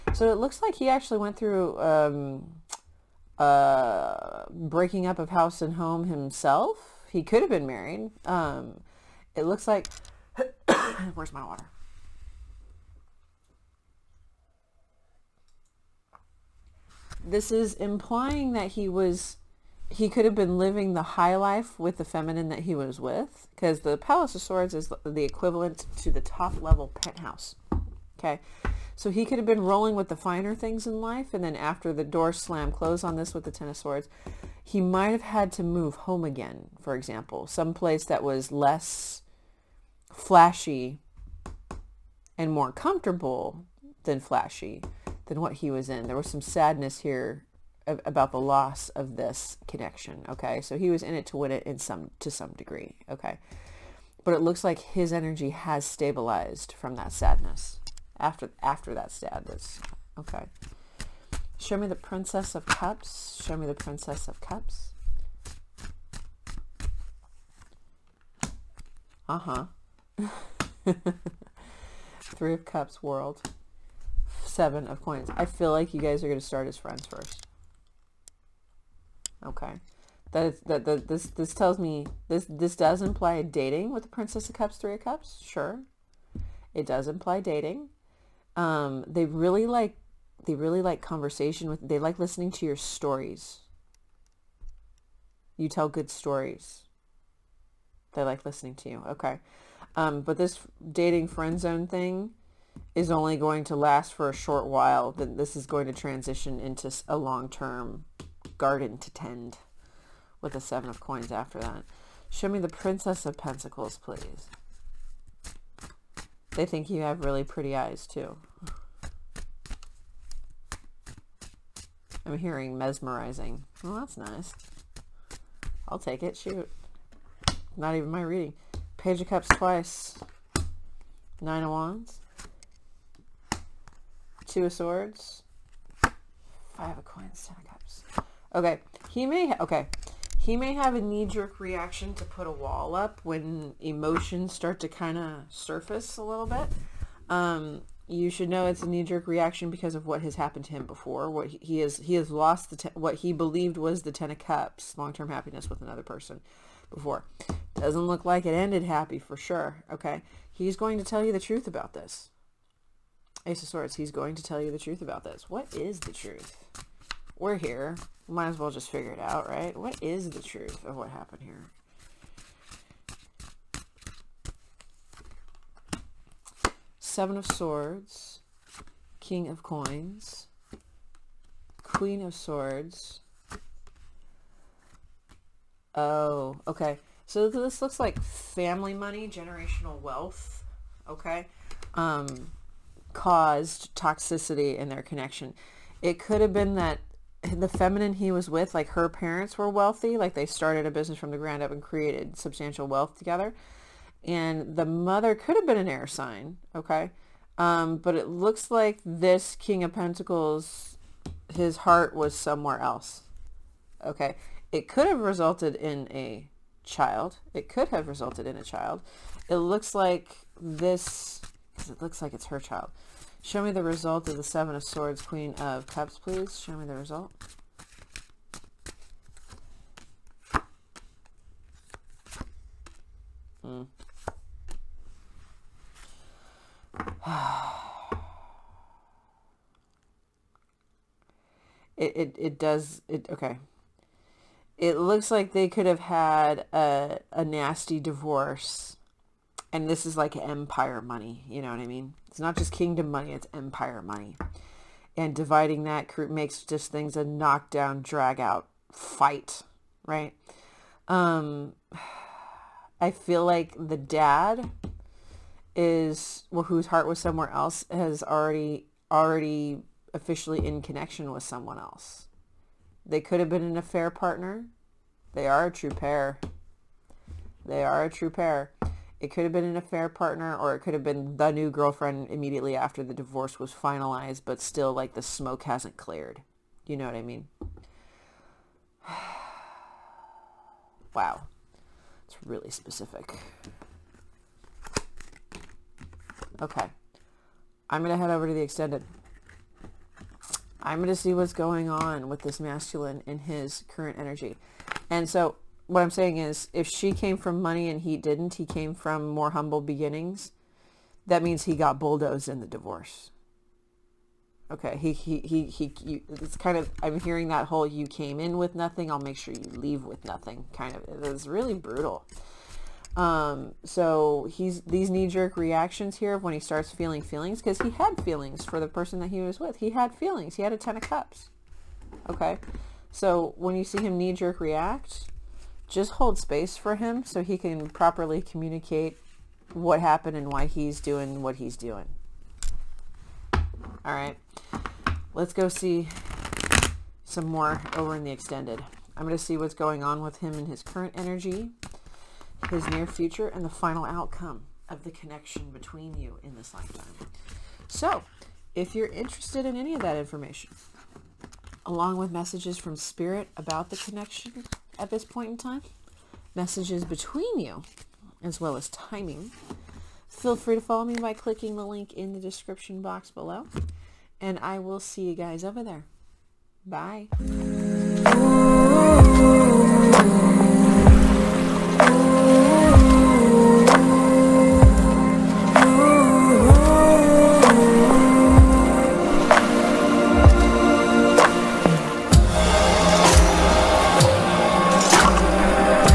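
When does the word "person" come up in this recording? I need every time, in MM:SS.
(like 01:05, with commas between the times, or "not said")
02:36, 05:28.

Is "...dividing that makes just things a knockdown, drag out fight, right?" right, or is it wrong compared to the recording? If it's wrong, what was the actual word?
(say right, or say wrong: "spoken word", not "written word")
right.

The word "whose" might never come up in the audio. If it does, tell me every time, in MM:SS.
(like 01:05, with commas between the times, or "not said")
04:26.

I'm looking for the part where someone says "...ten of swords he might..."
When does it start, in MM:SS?
00:33.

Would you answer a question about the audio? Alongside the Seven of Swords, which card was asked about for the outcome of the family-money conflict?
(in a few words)
Queen of Cups.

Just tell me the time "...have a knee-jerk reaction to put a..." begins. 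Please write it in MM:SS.
02:20.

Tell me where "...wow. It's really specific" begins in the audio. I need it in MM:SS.
04:51.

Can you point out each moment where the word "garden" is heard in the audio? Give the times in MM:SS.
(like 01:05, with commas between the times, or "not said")
01:48.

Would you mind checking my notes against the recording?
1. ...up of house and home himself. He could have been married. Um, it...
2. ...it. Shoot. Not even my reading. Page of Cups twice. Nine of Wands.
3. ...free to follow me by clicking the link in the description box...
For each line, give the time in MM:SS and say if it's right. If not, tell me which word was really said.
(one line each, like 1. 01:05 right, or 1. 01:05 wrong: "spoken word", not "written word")
1. 00:05 right
2. 02:06 right
3. 06:10 right.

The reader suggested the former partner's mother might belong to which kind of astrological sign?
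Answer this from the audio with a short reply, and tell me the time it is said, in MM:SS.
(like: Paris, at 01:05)
An air sign, at 03:25.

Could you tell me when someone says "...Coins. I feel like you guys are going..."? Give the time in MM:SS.
01:15.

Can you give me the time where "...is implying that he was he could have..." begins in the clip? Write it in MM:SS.
00:17.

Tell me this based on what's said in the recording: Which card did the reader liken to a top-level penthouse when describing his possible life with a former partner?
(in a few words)
Palace of Swords.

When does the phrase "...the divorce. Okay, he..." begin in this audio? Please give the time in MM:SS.
05:12.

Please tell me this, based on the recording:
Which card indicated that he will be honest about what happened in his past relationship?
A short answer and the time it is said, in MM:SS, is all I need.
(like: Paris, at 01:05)
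Ace of Swords, at 02:43.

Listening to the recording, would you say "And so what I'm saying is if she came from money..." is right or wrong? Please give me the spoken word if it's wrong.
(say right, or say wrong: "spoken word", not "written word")
right.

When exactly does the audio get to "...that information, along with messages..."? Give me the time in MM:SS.
06:00.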